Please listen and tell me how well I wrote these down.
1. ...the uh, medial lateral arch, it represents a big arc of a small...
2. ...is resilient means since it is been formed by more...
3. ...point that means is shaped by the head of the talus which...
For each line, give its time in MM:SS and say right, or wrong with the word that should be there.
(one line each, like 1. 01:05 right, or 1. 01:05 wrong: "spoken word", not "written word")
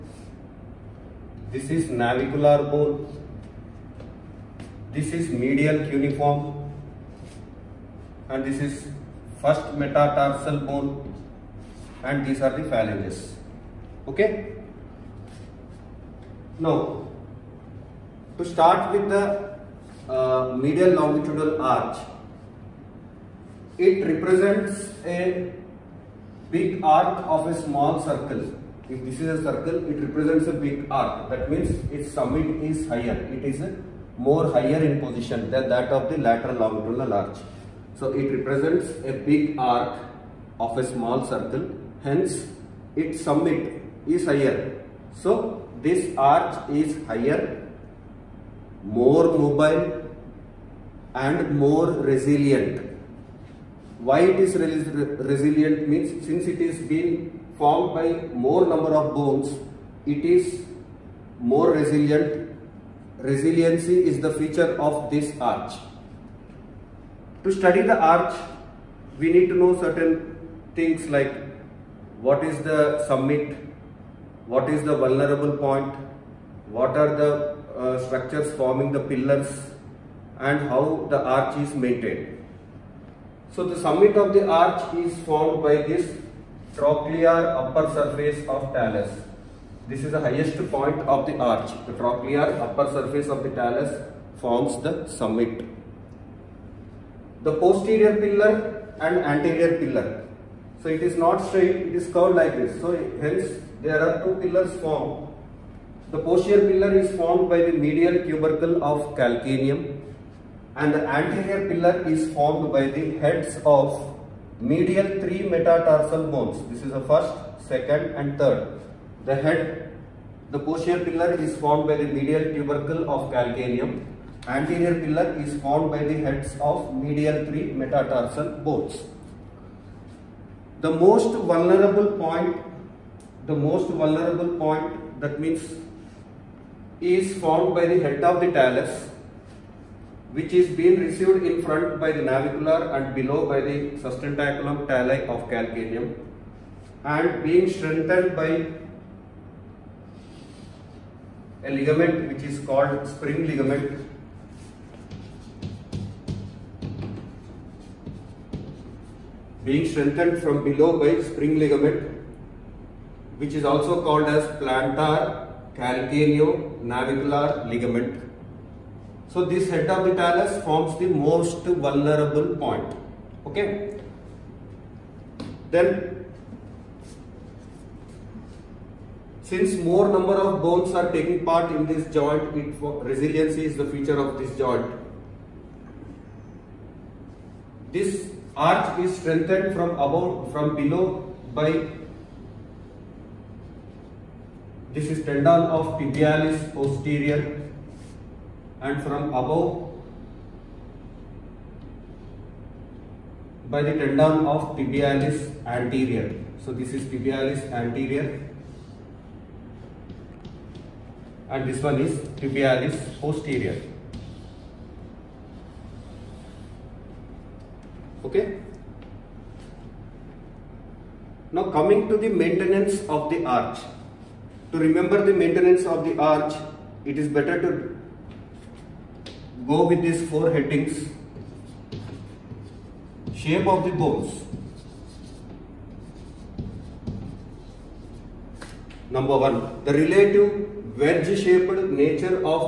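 1. 00:19 wrong: "longitudinal", not "lateral"
2. 00:54 right
3. 02:14 wrong: "formed", not "shaped".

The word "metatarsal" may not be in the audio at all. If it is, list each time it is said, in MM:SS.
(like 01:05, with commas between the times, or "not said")
00:09, 01:55, 02:07.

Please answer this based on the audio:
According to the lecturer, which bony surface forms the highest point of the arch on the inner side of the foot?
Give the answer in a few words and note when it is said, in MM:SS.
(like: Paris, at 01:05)
Trochlear upper surface of talus, at 01:26.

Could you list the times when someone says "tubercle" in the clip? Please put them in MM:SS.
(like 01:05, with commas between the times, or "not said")
01:48, 02:02.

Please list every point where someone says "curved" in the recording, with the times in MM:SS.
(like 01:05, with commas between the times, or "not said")
01:42.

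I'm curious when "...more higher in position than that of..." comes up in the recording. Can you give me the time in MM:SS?
00:34.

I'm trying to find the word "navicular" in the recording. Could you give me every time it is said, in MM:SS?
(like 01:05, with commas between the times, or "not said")
00:01, 02:22, 02:46.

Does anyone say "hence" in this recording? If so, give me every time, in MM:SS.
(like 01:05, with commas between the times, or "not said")
00:42, 01:43.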